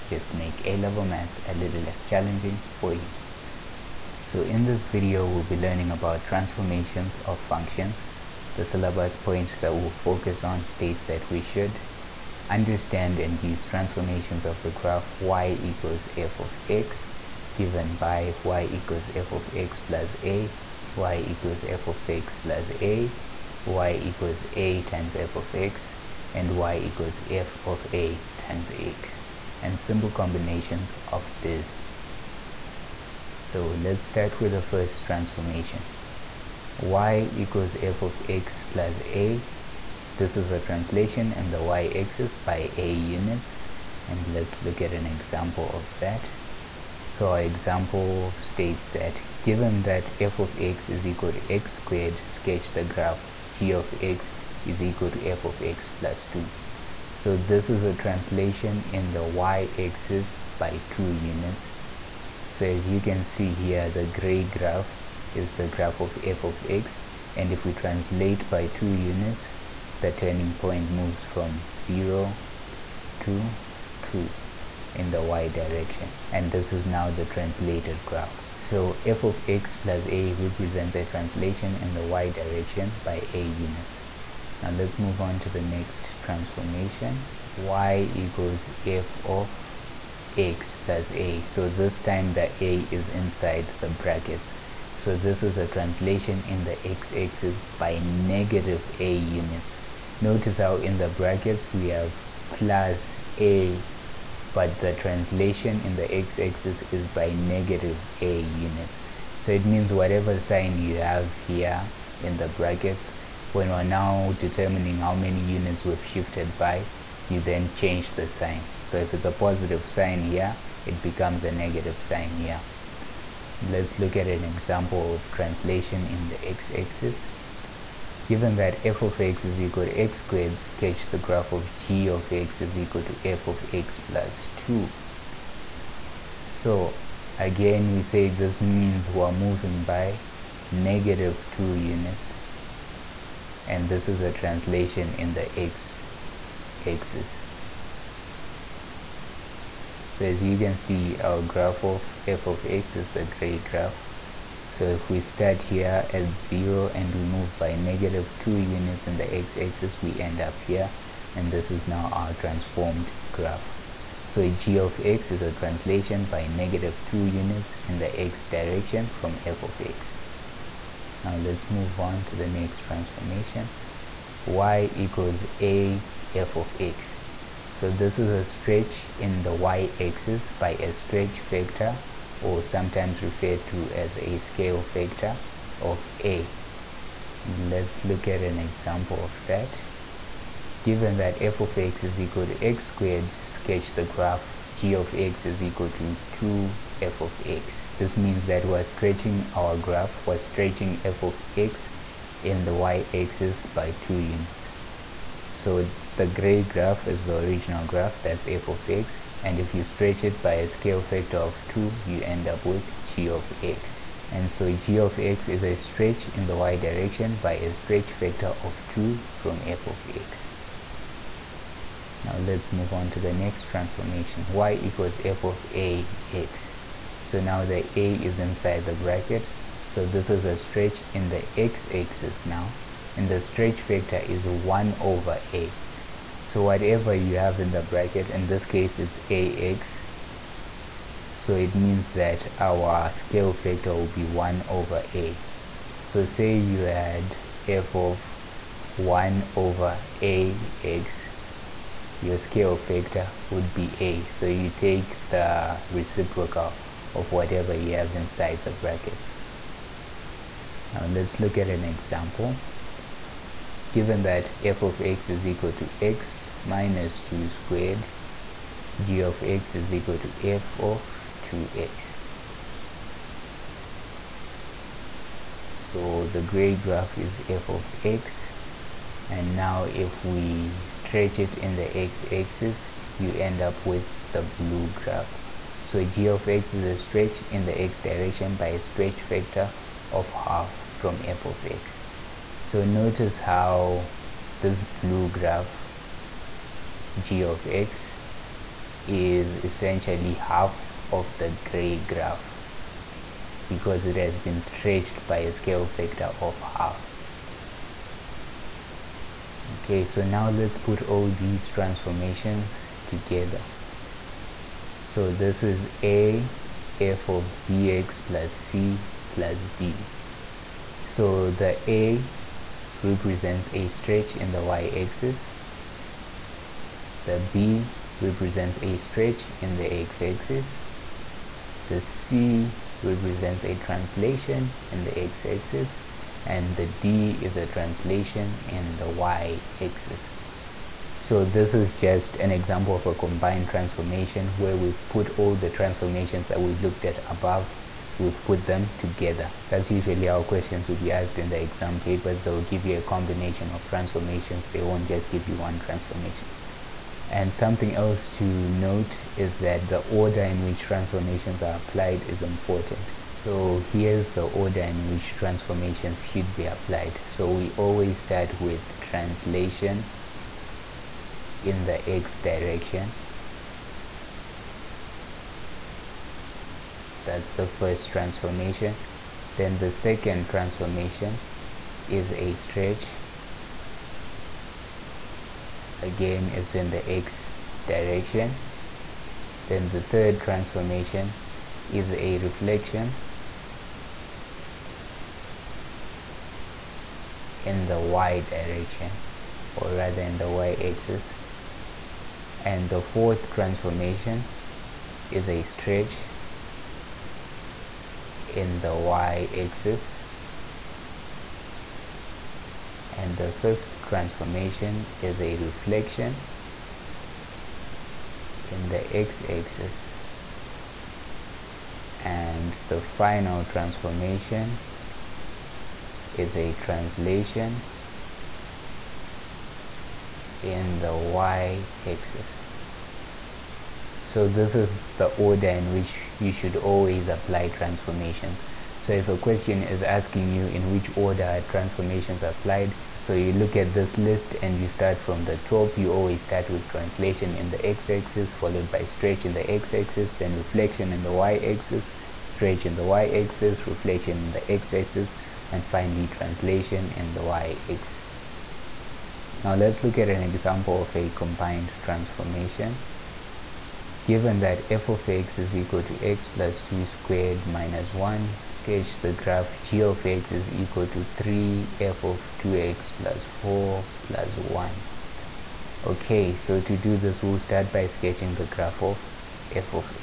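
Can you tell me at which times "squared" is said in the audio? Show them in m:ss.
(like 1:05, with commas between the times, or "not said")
0:51, 2:10, 3:12, 4:27, 7:47.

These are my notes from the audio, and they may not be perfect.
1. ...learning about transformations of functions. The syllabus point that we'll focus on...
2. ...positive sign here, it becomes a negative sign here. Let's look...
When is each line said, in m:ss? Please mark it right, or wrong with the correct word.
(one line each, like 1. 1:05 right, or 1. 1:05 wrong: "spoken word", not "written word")
1. 0:05 right
2. 1:59 right.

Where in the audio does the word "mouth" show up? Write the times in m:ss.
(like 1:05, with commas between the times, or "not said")
not said.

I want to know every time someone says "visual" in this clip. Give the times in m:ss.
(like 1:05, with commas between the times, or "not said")
not said.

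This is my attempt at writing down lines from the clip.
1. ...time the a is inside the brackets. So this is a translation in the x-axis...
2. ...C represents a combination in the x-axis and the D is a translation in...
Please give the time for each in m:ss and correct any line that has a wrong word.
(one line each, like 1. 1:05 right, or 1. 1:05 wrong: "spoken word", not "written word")
1. 1:31 right
2. 5:32 wrong: "translation", not "combination".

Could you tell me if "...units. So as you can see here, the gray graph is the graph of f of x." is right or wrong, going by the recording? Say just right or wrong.
right.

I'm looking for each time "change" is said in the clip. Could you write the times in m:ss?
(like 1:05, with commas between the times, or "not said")
1:57.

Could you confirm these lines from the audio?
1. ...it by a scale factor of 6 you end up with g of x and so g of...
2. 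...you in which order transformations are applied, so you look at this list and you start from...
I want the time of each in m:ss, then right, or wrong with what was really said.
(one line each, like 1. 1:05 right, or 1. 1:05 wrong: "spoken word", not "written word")
1. 3:30 wrong: "2", not "6"
2. 7:20 right.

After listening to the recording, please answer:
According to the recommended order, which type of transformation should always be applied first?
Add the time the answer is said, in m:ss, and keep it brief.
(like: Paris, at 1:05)
translation in the x direction, at 6:08.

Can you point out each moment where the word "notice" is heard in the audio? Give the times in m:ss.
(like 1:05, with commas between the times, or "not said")
1:40, 4:52.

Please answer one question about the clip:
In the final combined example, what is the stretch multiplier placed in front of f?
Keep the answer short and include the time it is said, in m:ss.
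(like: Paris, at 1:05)
3, at 7:51.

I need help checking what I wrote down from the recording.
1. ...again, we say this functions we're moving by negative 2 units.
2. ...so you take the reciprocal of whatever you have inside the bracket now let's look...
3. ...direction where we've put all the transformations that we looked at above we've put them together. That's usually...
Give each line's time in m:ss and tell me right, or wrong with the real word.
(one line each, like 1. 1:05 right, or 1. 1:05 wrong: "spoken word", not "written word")
1. 2:17 wrong: "means", not "functions"
2. 4:14 right
3. 5:43 wrong: "transformation", not "direction".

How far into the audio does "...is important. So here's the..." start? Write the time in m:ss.
6:02.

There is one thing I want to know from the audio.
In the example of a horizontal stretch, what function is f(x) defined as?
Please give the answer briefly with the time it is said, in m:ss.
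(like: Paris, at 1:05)
(x - 2)^2, at 4:26.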